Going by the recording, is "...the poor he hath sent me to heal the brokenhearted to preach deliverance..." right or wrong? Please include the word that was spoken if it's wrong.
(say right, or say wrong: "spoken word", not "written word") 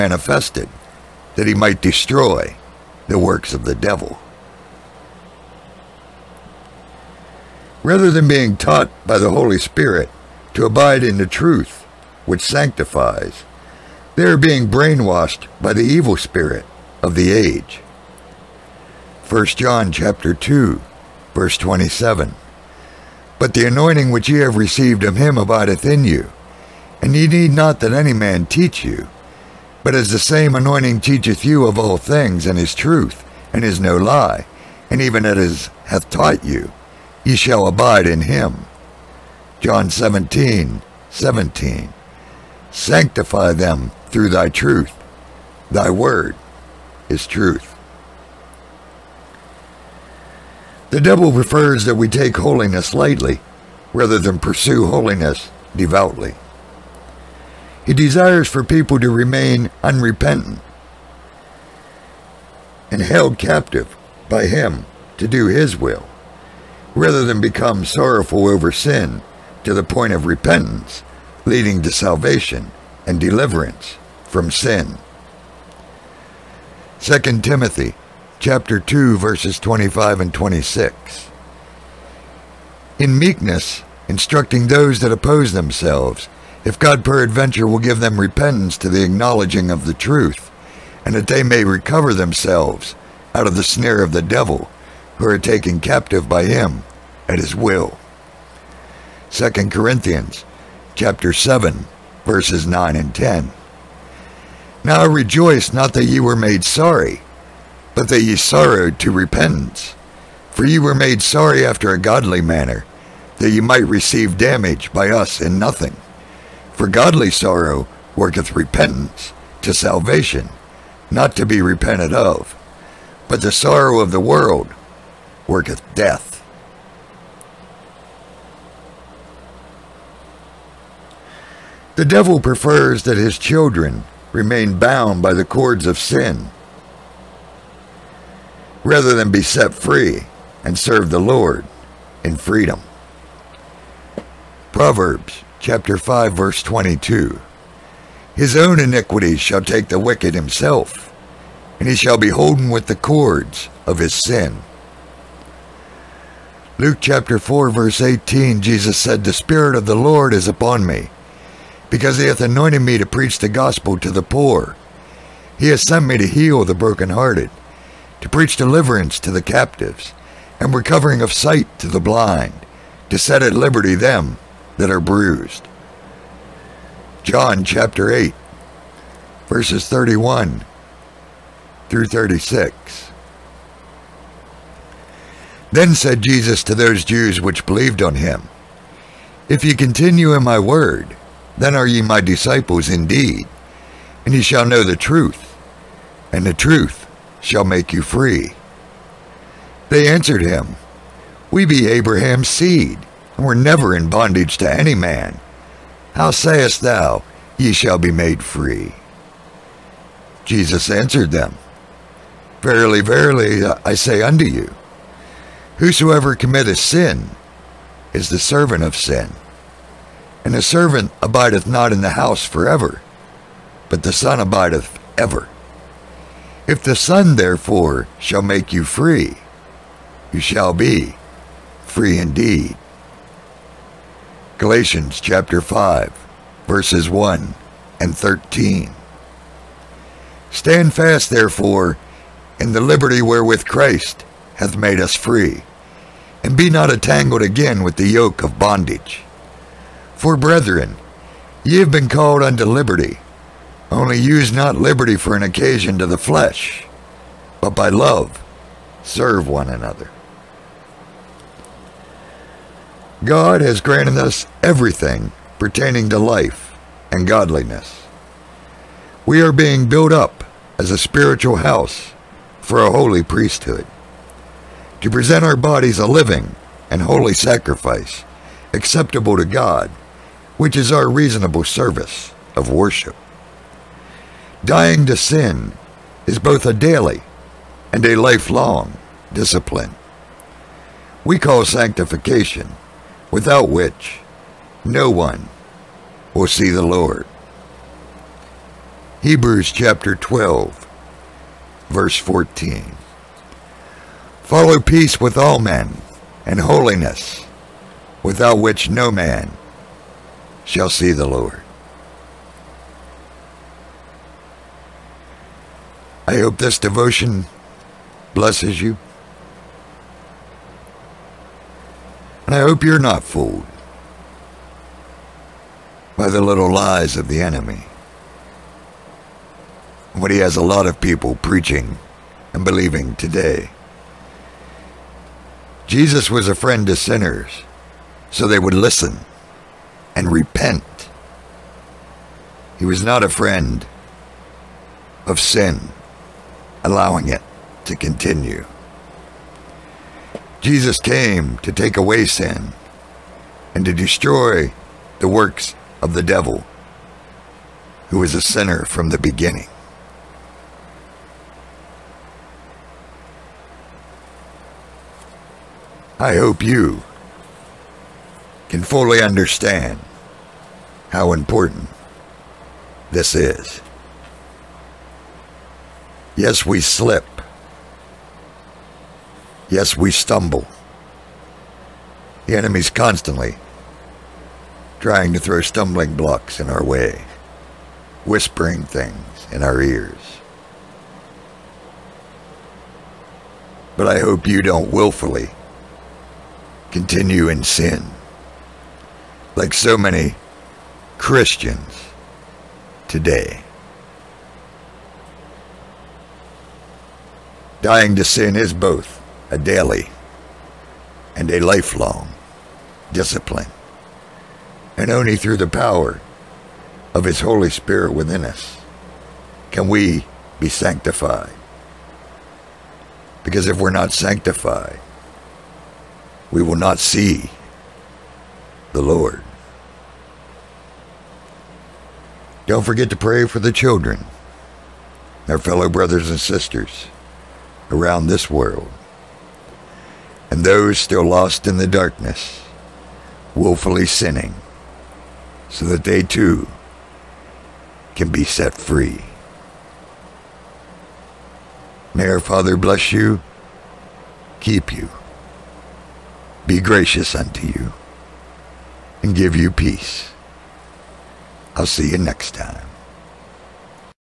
right.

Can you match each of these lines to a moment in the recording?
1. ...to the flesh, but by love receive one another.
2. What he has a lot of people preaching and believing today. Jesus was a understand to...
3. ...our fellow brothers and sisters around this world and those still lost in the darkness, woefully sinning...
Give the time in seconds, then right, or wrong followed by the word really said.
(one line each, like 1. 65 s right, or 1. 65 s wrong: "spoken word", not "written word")
1. 255 s wrong: "serve", not "receive"
2. 330 s wrong: "friend", not "understand"
3. 435 s right.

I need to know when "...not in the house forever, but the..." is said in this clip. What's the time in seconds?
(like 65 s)
221 s.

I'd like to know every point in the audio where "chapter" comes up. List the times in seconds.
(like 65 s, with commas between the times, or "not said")
19 s, 78 s, 100 s, 145 s, 157 s, 177 s, 235 s, 299 s.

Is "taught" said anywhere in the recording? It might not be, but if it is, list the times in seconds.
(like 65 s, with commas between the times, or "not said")
8 s, 36 s.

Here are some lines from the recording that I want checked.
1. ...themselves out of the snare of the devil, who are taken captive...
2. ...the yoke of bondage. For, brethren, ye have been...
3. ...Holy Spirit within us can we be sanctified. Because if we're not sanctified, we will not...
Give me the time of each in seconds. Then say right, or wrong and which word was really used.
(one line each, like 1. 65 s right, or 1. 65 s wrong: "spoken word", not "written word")
1. 92 s right
2. 247 s right
3. 417 s right.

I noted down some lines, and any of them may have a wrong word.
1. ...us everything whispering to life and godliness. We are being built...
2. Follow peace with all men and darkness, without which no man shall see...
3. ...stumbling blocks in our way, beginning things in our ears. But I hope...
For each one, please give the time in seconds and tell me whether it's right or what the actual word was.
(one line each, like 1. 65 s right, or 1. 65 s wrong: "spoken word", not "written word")
1. 264 s wrong: "pertaining", not "whispering"
2. 304 s wrong: "holiness", not "darkness"
3. 385 s wrong: "whispering", not "beginning".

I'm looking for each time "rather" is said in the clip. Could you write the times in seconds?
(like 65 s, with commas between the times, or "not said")
7 s, 53 s, 66 s, 138 s.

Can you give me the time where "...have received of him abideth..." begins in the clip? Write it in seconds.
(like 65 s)
24 s.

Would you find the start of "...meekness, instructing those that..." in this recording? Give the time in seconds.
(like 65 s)
83 s.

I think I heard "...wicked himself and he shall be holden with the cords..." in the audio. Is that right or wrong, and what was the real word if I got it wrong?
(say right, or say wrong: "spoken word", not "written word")
right.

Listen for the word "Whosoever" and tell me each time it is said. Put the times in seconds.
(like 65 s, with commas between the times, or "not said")
215 s.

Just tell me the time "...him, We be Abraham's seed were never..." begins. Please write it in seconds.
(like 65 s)
200 s.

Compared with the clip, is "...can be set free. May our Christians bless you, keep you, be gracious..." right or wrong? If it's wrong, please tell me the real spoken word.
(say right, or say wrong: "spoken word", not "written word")
wrong: "Father", not "Christians".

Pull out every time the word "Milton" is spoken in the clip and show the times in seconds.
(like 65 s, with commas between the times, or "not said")
not said.